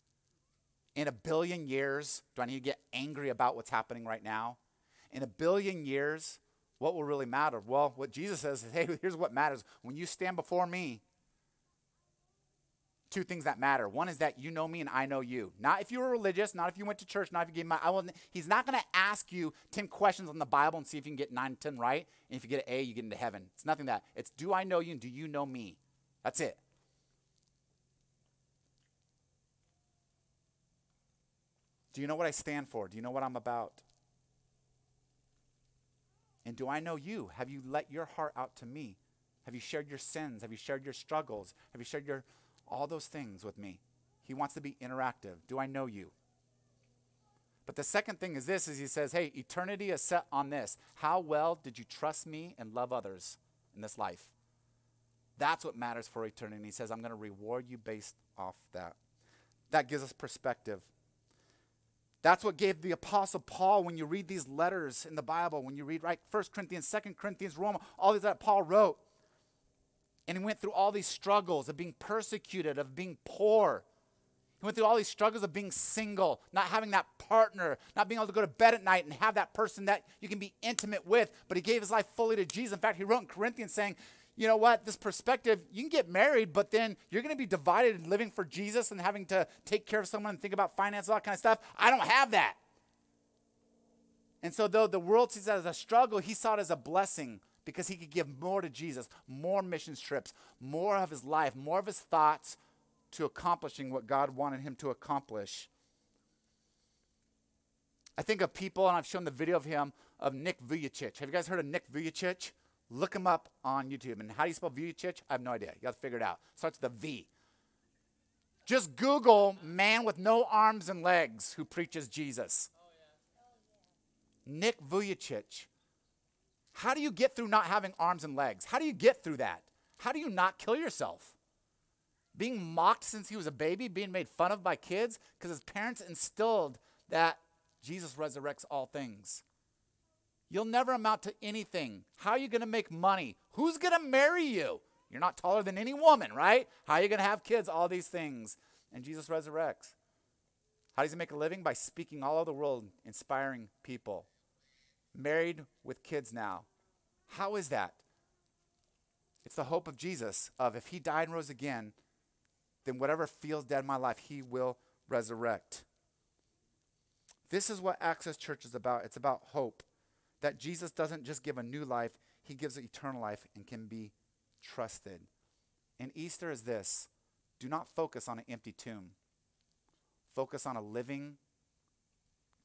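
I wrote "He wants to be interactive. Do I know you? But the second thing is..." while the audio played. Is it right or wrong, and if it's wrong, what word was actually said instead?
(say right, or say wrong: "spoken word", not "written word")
right.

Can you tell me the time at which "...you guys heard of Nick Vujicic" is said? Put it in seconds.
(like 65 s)
111 s.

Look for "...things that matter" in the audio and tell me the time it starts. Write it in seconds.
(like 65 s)
13 s.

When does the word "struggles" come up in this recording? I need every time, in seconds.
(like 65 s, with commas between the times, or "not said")
40 s, 71 s, 75 s, 95 s.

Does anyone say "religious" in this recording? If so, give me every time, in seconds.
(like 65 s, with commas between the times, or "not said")
16 s.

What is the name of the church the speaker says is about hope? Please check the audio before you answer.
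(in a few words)
Access Church.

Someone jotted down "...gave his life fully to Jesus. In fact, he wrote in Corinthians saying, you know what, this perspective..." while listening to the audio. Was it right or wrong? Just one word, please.
right.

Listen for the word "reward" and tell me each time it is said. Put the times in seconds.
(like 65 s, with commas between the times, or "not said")
57 s.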